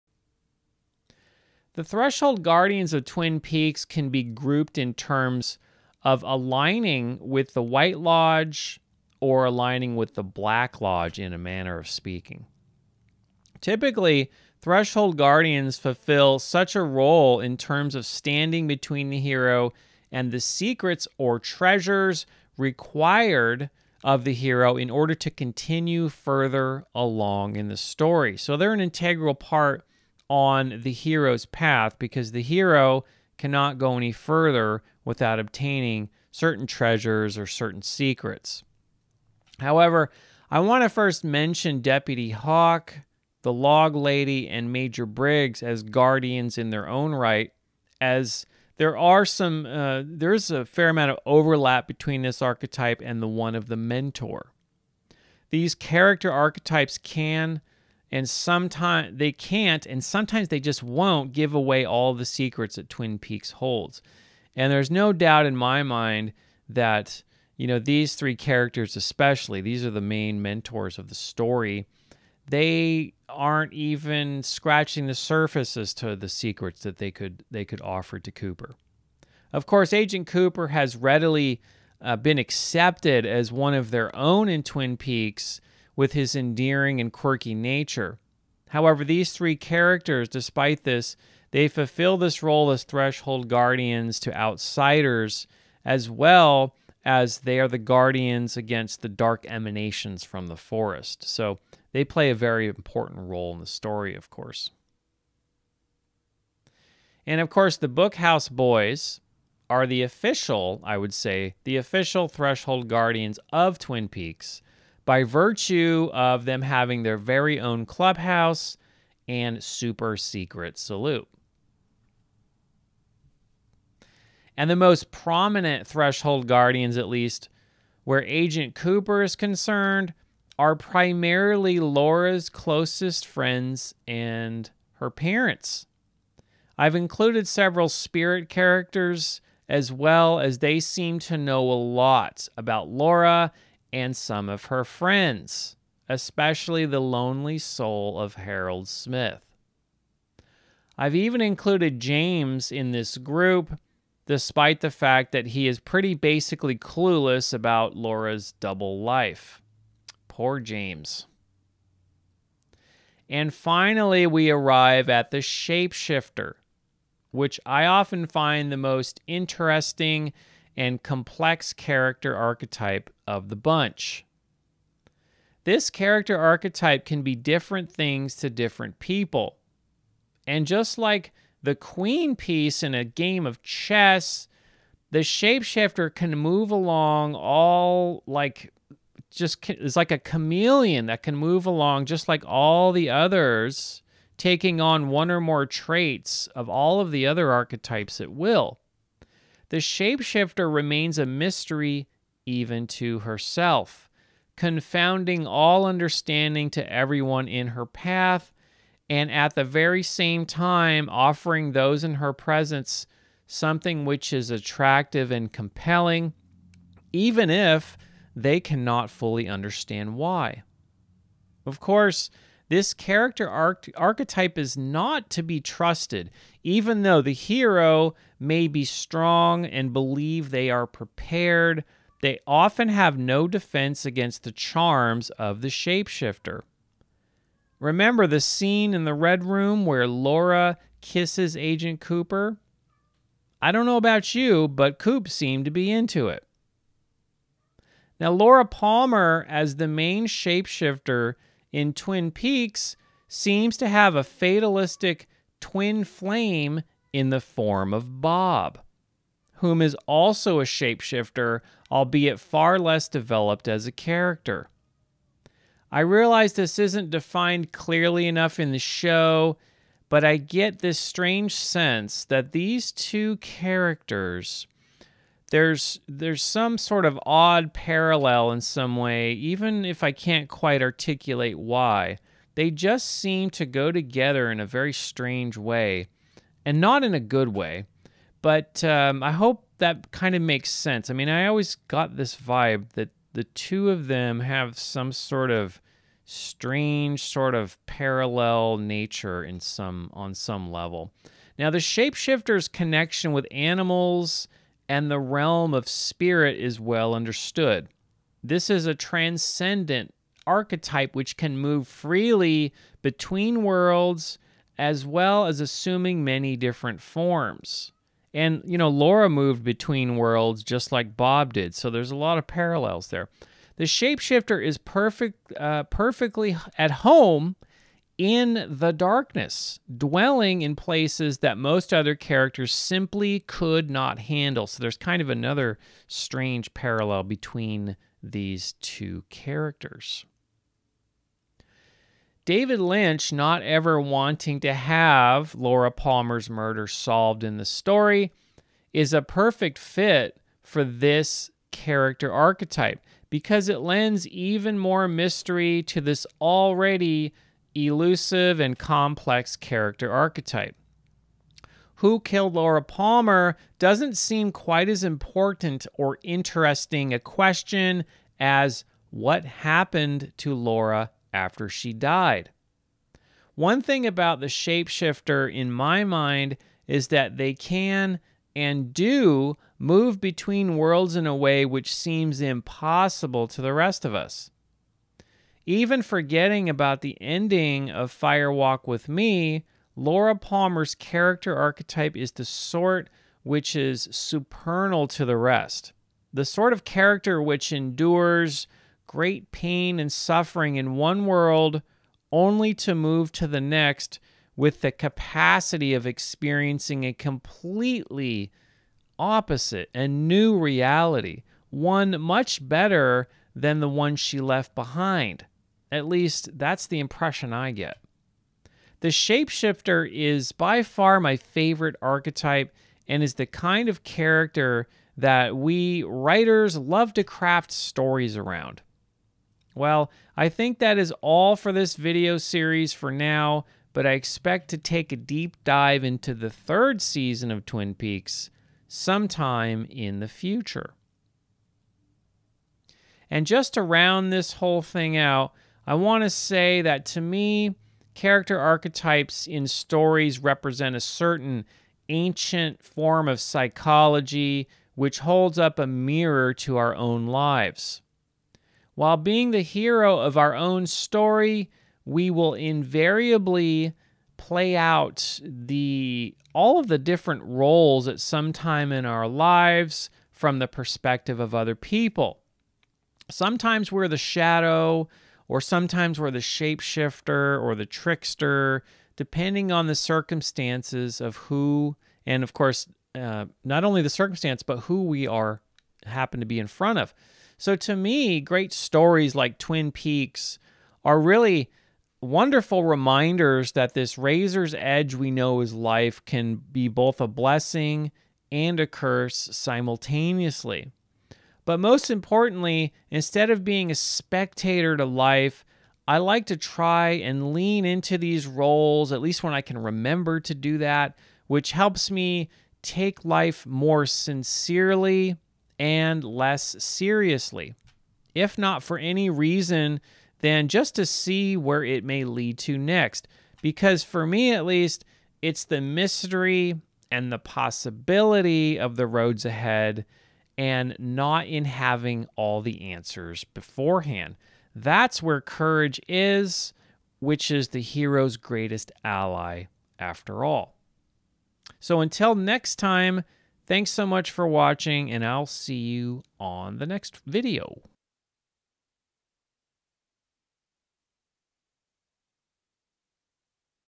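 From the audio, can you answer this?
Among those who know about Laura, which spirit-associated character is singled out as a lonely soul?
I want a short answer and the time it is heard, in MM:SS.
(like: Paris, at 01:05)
Harold Smith, at 02:28.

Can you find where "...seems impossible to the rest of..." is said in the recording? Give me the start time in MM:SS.
06:21.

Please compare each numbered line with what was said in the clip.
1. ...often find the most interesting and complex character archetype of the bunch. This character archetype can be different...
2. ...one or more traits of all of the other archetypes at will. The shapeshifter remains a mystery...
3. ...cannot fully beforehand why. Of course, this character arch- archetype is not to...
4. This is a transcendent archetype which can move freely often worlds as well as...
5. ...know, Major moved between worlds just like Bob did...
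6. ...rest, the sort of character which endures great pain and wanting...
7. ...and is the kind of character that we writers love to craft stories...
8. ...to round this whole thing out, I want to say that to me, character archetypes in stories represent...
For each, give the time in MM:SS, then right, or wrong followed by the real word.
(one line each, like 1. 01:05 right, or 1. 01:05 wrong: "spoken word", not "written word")
1. 02:47 right
2. 03:15 right
3. 03:38 wrong: "understand", not "beforehand"
4. 05:08 wrong: "between", not "often"
5. 05:18 wrong: "Laura", not "Major"
6. 06:35 wrong: "suffering", not "wanting"
7. 07:03 right
8. 07:23 right.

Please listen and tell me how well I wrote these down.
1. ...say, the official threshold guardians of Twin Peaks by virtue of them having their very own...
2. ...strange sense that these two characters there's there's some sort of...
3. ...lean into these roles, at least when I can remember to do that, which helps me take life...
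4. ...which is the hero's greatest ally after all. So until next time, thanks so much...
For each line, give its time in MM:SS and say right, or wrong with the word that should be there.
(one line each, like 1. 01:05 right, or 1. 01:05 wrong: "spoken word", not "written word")
1. 01:51 right
2. 04:30 right
3. 08:27 right
4. 08:57 right.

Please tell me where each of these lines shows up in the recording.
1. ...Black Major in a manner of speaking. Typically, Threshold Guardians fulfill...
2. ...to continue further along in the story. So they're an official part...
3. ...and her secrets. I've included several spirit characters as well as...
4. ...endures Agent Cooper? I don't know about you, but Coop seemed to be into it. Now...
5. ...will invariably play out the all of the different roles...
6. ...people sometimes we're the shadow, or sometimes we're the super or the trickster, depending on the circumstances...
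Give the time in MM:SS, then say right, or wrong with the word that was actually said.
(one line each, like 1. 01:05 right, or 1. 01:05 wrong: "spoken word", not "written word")
1. 00:10 wrong: "Lodge", not "Major"
2. 00:25 wrong: "integral", not "official"
3. 02:14 wrong: "parents", not "secrets"
4. 04:01 wrong: "kisses", not "endures"
5. 07:42 right
6. 07:51 wrong: "shapeshifter", not "super".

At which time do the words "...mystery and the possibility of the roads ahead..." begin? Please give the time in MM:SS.
08:45.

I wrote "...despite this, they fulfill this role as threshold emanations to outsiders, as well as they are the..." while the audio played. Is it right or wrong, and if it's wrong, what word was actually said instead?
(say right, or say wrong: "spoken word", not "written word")
wrong: "guardians", not "emanations".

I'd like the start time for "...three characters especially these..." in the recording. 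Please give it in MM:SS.
01:08.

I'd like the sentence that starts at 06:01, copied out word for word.
Who killed Laura Palmer doesn't seem quite as important or interesting a question as what happened to Laura after she died.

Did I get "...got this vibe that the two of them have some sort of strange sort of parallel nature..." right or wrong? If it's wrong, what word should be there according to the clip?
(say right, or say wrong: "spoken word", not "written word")
right.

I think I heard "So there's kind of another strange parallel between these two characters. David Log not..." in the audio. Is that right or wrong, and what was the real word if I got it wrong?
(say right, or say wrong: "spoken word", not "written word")
wrong: "Lynch", not "Log".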